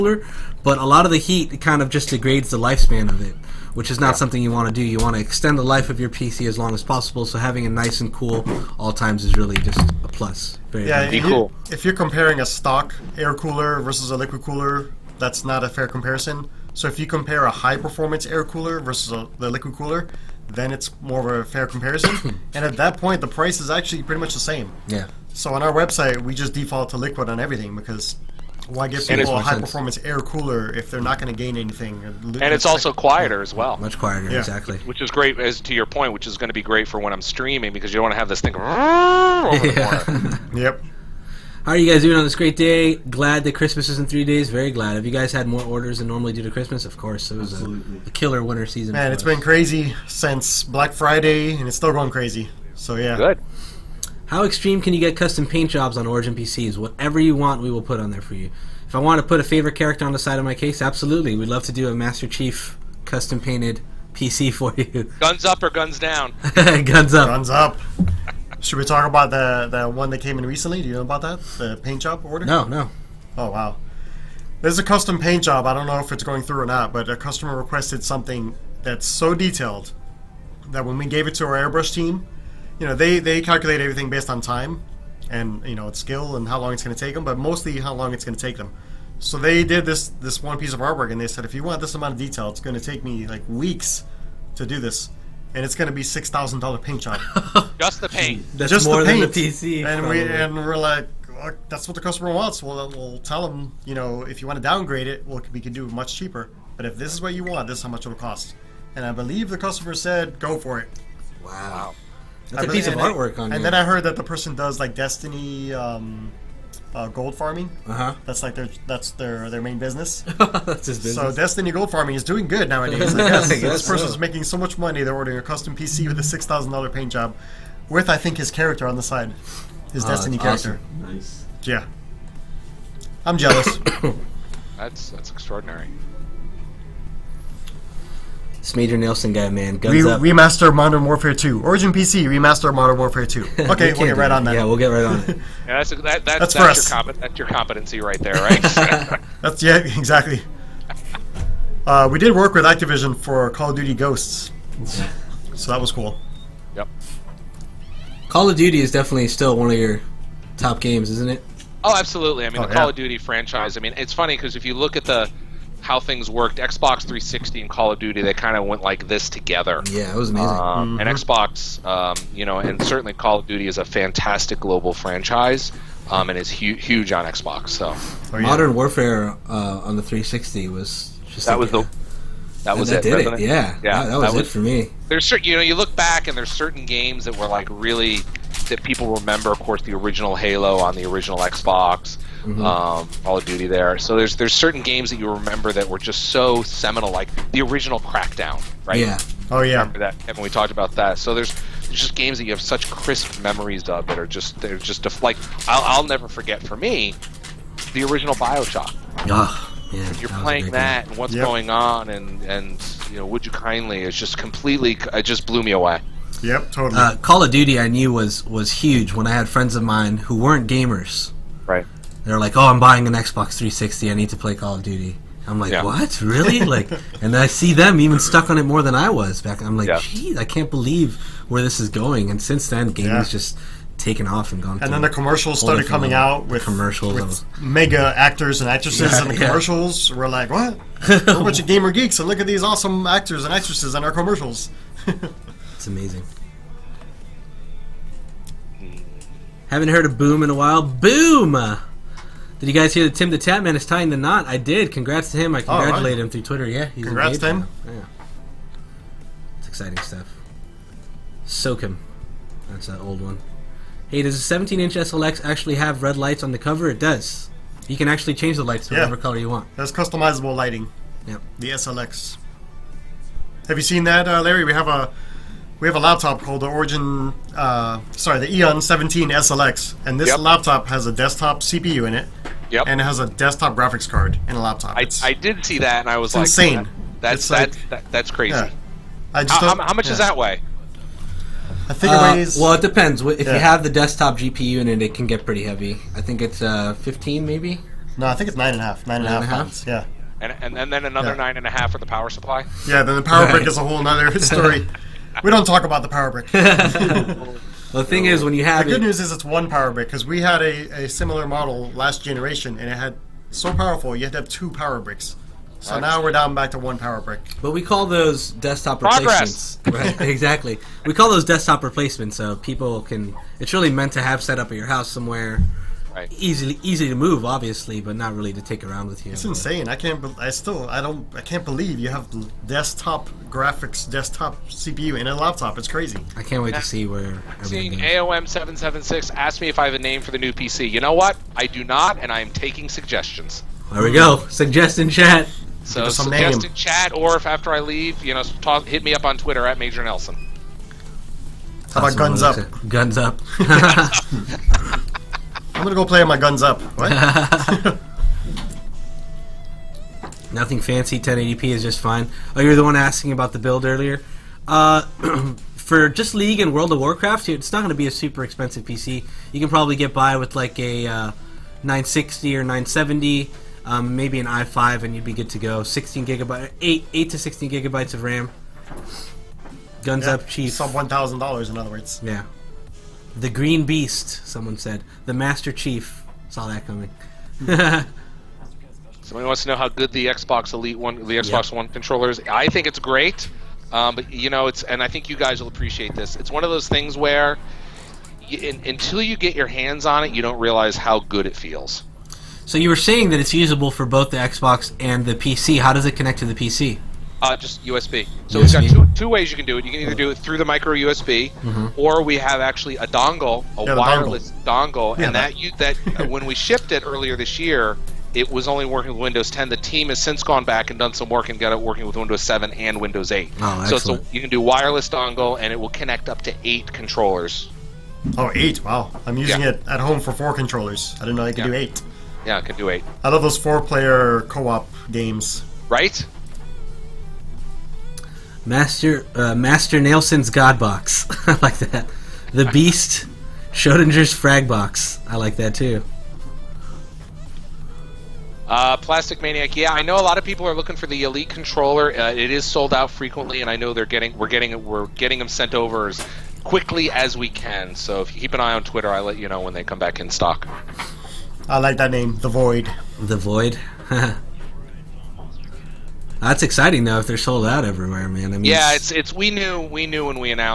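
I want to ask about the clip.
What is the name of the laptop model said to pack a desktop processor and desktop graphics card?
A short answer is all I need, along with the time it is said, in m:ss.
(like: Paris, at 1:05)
Eon 17 SLX, at 4:38.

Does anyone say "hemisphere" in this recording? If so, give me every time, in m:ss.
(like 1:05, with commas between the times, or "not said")
not said.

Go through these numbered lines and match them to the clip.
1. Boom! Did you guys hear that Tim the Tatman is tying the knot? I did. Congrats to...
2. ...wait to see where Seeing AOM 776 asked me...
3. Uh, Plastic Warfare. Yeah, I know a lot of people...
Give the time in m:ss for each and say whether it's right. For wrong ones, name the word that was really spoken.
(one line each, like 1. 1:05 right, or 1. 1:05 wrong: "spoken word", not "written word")
1. 4:10 right
2. 5:36 right
3. 7:28 wrong: "Maniac", not "Warfare".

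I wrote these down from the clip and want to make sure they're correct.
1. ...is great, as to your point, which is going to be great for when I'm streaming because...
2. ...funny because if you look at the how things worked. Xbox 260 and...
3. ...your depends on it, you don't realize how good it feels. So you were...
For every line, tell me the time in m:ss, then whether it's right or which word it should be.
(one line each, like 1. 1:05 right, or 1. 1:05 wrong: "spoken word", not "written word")
1. 0:34 right
2. 2:44 wrong: "360", not "260"
3. 6:39 wrong: "hands", not "depends".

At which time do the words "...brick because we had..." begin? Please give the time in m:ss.
5:09.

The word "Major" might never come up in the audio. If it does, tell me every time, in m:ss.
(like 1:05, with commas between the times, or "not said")
2:18, 5:49.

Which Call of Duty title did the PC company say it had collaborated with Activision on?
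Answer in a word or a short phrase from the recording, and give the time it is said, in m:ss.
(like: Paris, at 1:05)
Call of Duty Ghosts, at 2:33.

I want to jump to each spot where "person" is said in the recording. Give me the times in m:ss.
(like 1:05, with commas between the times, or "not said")
1:54, 2:03.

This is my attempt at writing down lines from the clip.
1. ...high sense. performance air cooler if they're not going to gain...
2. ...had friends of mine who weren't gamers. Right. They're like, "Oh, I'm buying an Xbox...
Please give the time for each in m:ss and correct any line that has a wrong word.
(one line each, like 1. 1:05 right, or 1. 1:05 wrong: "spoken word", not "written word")
1. 0:29 right
2. 3:39 right.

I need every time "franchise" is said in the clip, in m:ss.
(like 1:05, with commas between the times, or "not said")
2:43, 2:54.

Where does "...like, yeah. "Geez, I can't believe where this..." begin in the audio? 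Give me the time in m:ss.
3:49.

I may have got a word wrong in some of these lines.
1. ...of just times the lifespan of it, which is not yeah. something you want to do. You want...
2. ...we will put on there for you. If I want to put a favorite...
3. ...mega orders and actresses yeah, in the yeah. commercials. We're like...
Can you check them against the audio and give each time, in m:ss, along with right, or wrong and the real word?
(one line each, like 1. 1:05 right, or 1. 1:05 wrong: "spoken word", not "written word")
1. 0:01 wrong: "degrades", not "times"
2. 0:57 right
3. 3:57 wrong: "actors", not "orders".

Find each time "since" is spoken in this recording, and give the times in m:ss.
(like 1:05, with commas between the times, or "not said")
0:50, 3:52, 7:00.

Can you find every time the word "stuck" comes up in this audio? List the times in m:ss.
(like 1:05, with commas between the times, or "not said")
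3:48.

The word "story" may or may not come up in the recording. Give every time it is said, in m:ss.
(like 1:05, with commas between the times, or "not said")
5:04.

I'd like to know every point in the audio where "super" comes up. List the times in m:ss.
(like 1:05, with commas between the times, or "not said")
6:08.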